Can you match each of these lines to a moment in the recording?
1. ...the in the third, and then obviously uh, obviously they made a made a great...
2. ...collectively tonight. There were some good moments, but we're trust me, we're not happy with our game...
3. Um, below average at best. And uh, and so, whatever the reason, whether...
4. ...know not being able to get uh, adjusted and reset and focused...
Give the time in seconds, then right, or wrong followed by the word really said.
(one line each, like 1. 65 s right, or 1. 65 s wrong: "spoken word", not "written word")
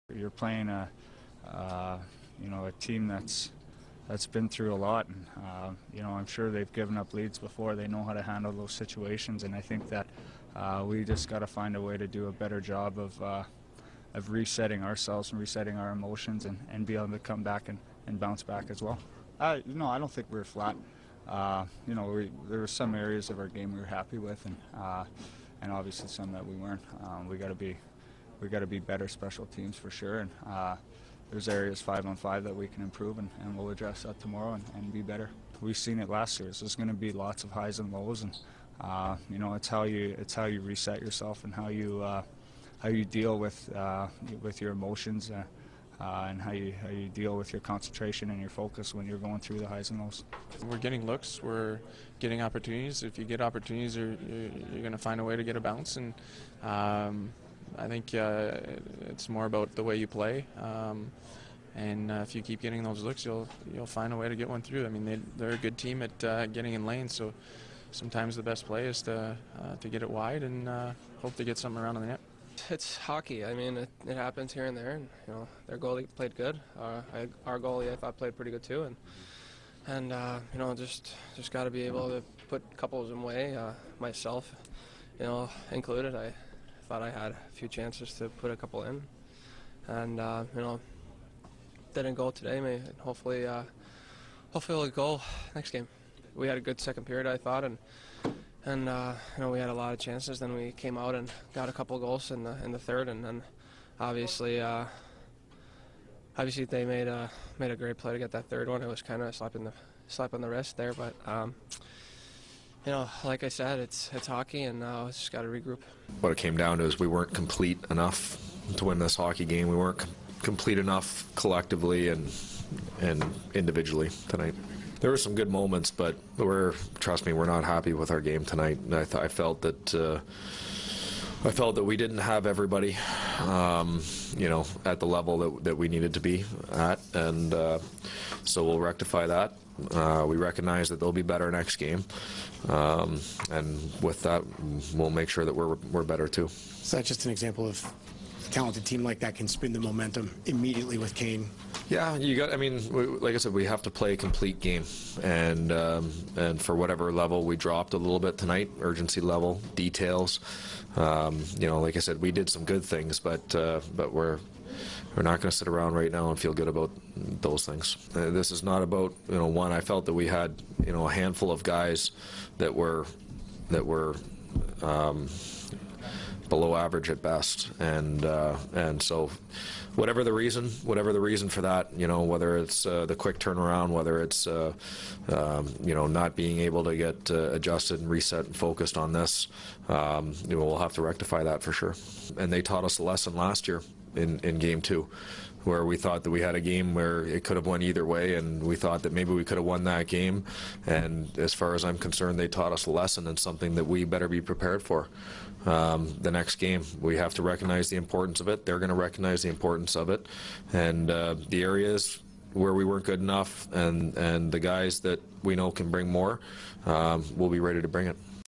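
1. 102 s right
2. 123 s wrong: "individually", not "collectively"
3. 174 s wrong: "whatever", not "whether"
4. 185 s right.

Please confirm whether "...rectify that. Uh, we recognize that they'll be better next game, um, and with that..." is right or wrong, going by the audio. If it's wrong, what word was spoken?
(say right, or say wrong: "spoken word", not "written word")
right.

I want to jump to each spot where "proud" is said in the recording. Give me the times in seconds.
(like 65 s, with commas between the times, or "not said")
not said.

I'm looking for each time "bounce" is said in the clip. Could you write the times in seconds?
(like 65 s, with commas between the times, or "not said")
18 s, 55 s.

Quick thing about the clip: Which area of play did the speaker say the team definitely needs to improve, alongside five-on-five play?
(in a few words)
special teams.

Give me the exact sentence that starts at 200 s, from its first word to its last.
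And as far as I'm concerned, they taught us a lesson and something that we better be prepared for.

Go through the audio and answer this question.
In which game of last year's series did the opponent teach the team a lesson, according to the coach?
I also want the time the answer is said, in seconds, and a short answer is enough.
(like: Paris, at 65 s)
Game 2, at 194 s.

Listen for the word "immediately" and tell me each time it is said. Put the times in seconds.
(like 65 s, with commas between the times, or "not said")
150 s.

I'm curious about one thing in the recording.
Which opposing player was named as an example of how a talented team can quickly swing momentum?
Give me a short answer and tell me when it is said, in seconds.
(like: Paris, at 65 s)
Kane, at 151 s.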